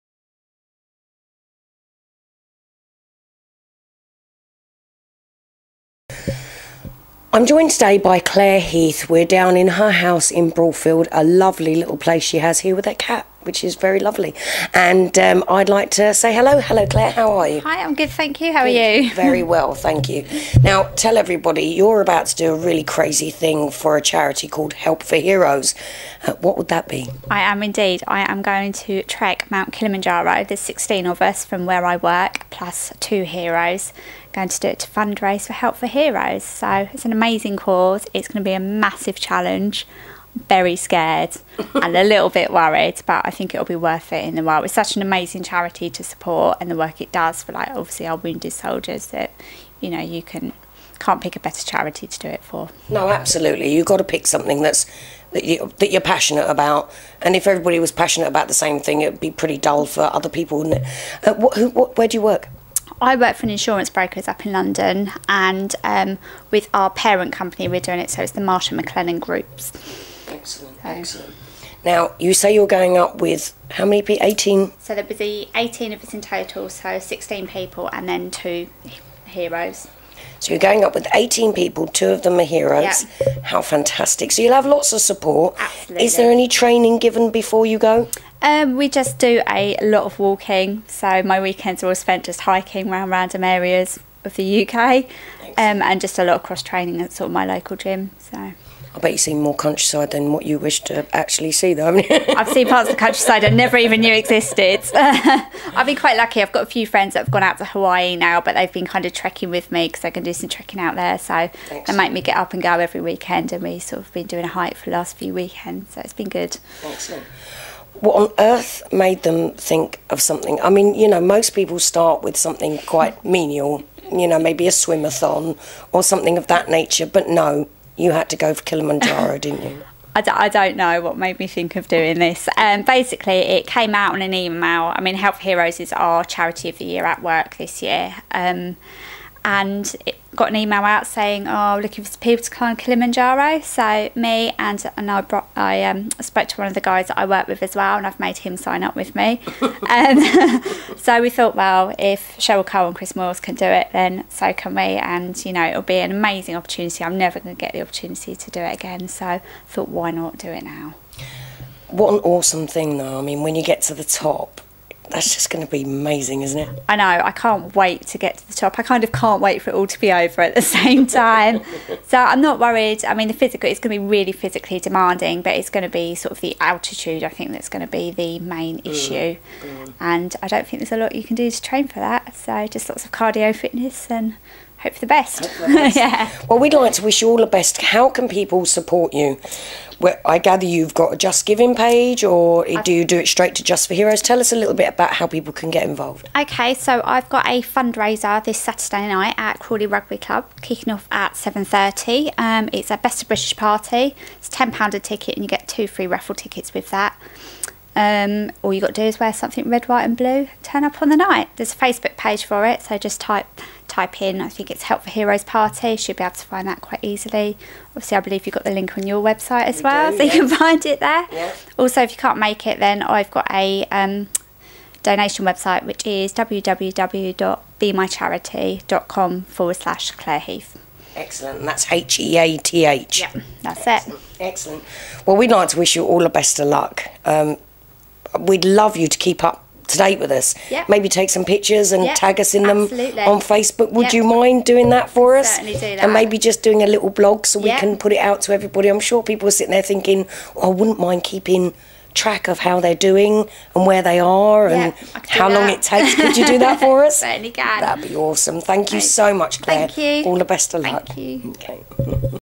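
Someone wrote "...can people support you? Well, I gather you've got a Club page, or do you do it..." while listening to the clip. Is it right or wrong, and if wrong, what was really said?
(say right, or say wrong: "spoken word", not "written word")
wrong: "JustGiving", not "Club".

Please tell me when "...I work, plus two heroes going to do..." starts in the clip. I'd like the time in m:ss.
0:31.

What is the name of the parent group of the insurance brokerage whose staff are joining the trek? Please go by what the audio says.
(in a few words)
Marsh and McLennan.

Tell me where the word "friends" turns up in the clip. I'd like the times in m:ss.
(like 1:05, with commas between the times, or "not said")
1:46.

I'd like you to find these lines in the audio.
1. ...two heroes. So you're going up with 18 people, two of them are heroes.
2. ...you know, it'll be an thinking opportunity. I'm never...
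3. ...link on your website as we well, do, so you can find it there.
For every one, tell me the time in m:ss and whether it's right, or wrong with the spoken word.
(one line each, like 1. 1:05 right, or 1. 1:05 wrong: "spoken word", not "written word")
1. 1:18 right
2. 2:35 wrong: "amazing", not "thinking"
3. 3:38 right.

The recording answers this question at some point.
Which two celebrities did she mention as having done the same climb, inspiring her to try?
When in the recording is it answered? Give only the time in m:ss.
2:32.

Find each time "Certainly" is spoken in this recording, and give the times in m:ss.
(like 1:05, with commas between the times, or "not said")
4:05, 4:17.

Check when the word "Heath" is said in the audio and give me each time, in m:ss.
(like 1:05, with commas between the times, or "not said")
0:08, 3:50.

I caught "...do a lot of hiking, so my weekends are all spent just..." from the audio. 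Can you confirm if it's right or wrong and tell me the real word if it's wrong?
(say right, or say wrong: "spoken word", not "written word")
wrong: "walking", not "hiking".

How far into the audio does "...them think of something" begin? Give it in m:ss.
1:59.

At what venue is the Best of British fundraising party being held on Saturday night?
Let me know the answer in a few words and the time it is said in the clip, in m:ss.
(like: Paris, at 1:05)
Crawley Rugby Club, at 3:19.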